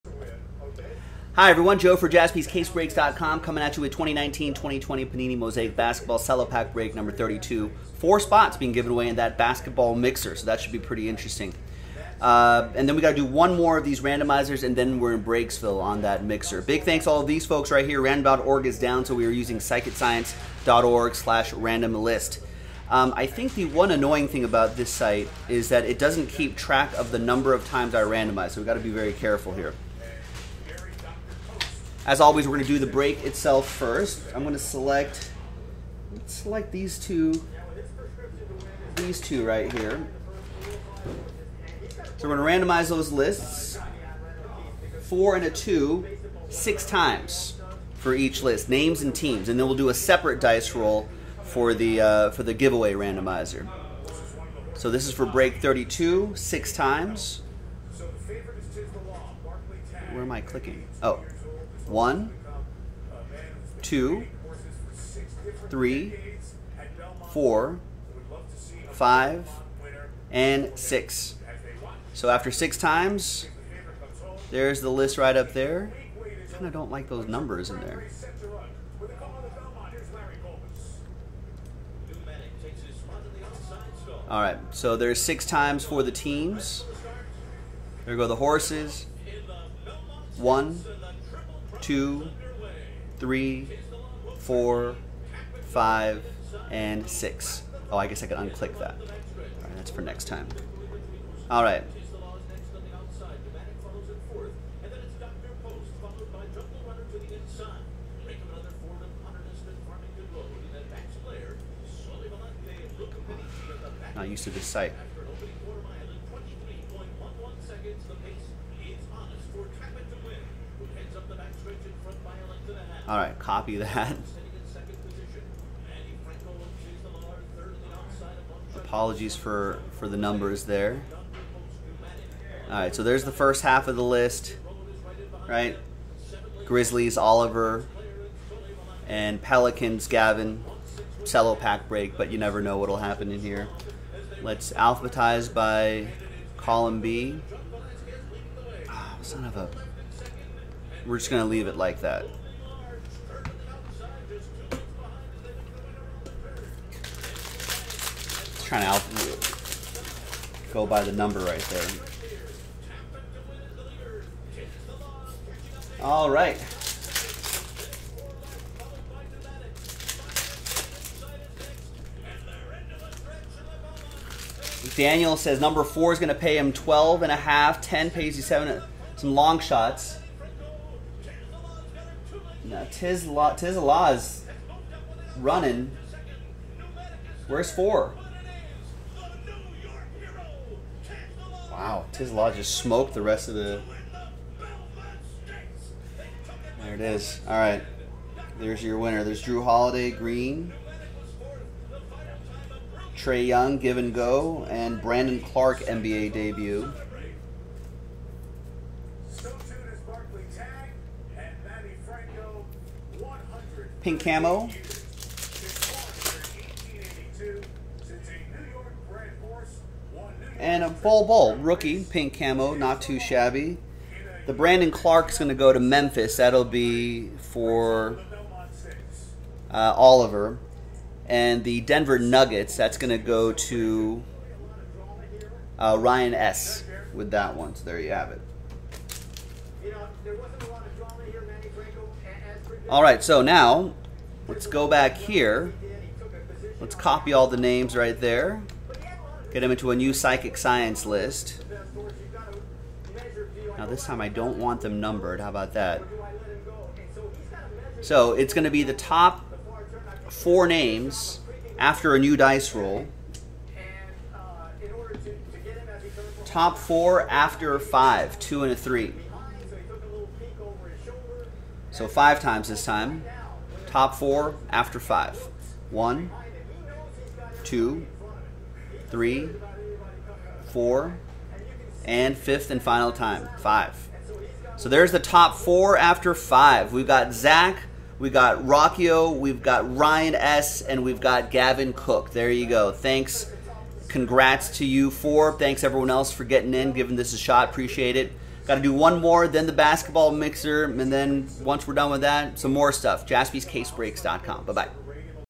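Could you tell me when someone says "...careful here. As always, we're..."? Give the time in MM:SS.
00:29.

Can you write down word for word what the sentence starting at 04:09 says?
Get them into a new psychic science list.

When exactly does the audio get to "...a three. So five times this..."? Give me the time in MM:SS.
04:28.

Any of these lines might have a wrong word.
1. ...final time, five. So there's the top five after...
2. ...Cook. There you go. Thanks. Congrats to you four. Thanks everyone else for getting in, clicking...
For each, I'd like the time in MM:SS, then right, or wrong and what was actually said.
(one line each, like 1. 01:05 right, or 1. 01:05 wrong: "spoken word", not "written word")
1. 04:42 wrong: "four", not "five"
2. 04:51 wrong: "giving", not "clicking".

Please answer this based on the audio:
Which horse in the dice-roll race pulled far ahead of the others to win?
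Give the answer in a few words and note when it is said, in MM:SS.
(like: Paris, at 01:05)
Tiz La, at 03:03.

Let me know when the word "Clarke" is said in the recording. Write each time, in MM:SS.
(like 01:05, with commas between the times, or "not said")
03:25, 03:44.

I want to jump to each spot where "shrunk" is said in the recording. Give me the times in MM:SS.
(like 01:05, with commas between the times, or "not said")
not said.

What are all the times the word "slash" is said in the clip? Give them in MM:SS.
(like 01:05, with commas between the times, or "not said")
00:21.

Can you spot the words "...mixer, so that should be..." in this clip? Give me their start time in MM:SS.
00:09.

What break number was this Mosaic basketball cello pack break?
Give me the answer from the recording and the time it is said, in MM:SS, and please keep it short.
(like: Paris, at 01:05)
32, at 00:06.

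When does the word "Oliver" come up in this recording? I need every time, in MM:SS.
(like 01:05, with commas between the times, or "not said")
02:17, 03:49.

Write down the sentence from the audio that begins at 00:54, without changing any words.
So this is for break 32, six times where am I clicking?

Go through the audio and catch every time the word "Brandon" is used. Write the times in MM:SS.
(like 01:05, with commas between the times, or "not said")
03:25, 03:44.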